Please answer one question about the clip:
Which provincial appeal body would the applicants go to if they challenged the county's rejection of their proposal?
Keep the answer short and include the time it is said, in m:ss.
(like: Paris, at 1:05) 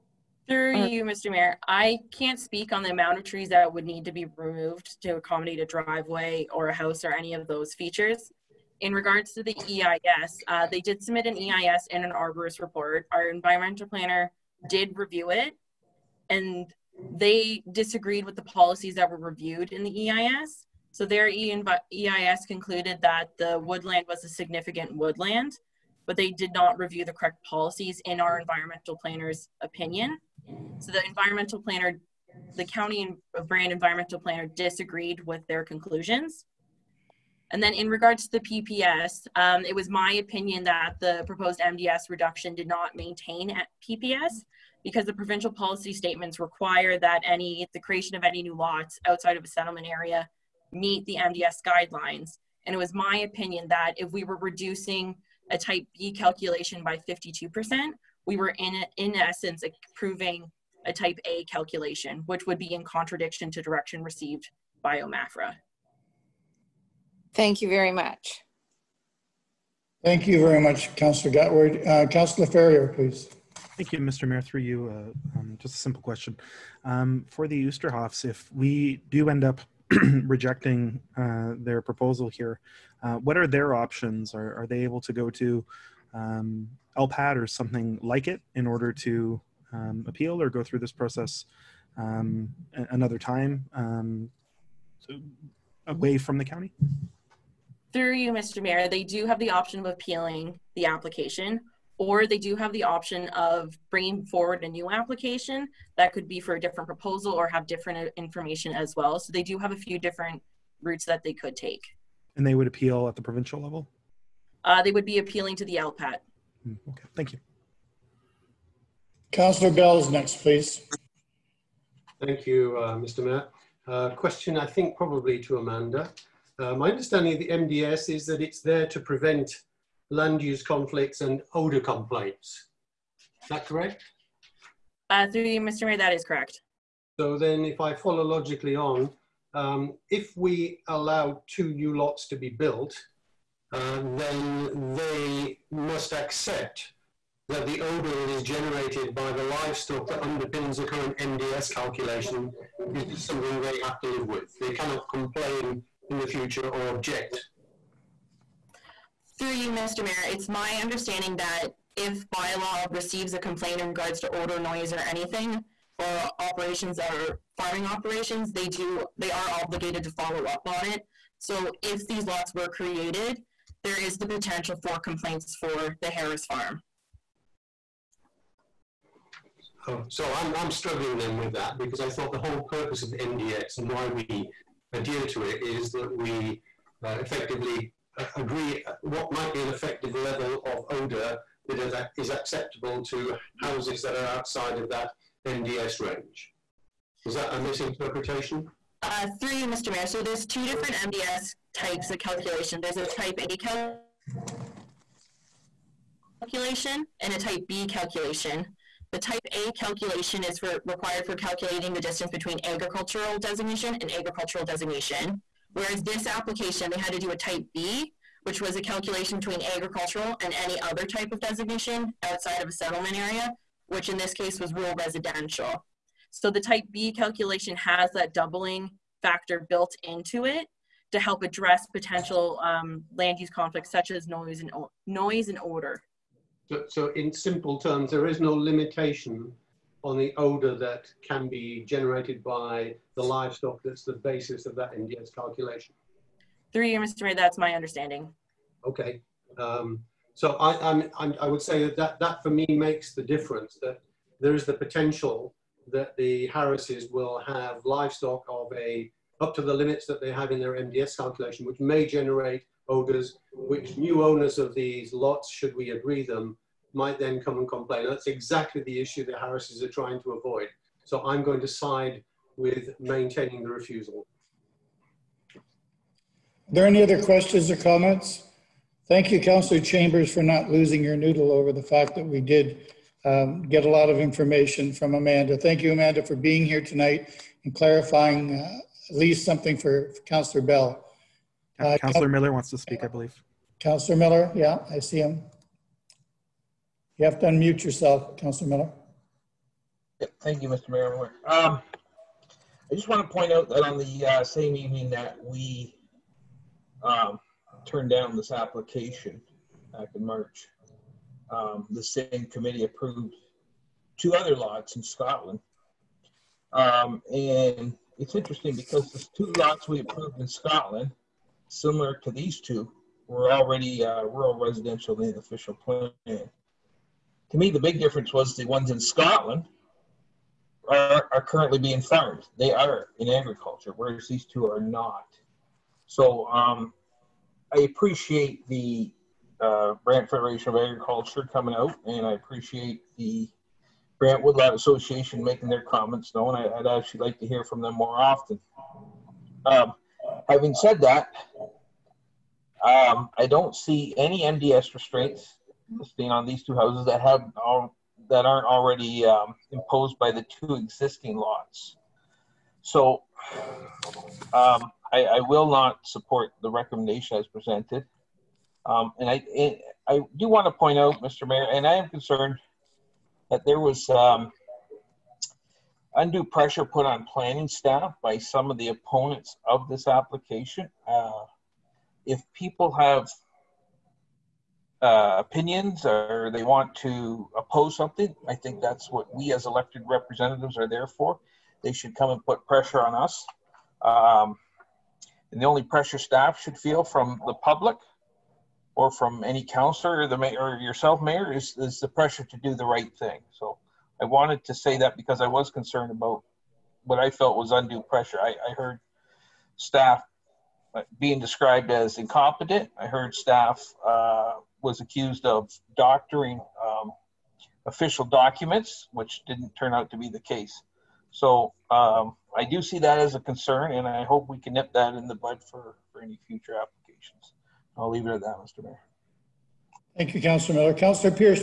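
LPAT, at 1:55.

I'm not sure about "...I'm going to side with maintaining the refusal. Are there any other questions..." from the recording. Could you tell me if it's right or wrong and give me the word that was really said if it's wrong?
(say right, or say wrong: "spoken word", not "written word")
right.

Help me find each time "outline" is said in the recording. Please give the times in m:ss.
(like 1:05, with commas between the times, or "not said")
not said.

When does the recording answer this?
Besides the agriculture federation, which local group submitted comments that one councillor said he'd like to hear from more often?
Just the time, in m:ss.
5:44.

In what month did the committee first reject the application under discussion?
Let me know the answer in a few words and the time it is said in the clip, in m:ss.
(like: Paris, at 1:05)
March, at 5:10.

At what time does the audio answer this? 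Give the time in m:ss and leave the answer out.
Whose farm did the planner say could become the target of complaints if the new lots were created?
2:56.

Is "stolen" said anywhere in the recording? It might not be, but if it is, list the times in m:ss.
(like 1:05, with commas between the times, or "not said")
not said.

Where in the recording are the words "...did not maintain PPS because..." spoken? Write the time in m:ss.
0:42.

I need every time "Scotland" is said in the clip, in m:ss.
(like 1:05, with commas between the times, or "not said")
5:15, 5:20, 5:28.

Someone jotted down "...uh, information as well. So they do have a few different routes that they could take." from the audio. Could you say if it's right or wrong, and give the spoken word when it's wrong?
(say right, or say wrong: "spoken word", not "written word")
right.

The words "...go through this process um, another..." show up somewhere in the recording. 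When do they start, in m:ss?
1:30.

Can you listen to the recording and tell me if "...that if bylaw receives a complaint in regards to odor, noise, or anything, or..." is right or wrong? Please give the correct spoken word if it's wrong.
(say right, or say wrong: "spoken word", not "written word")
right.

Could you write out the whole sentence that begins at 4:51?
Uh, Councillor Miller wants to speak, I believe.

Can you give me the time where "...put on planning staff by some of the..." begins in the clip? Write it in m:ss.
6:16.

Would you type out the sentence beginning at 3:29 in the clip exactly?
The type A calculation is for, required for calculating the distance between agricultural designation and agricultural designation.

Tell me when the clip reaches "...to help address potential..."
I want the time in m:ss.
3:51.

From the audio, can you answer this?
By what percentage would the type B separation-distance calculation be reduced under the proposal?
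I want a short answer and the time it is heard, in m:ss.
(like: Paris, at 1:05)
52%, at 0:57.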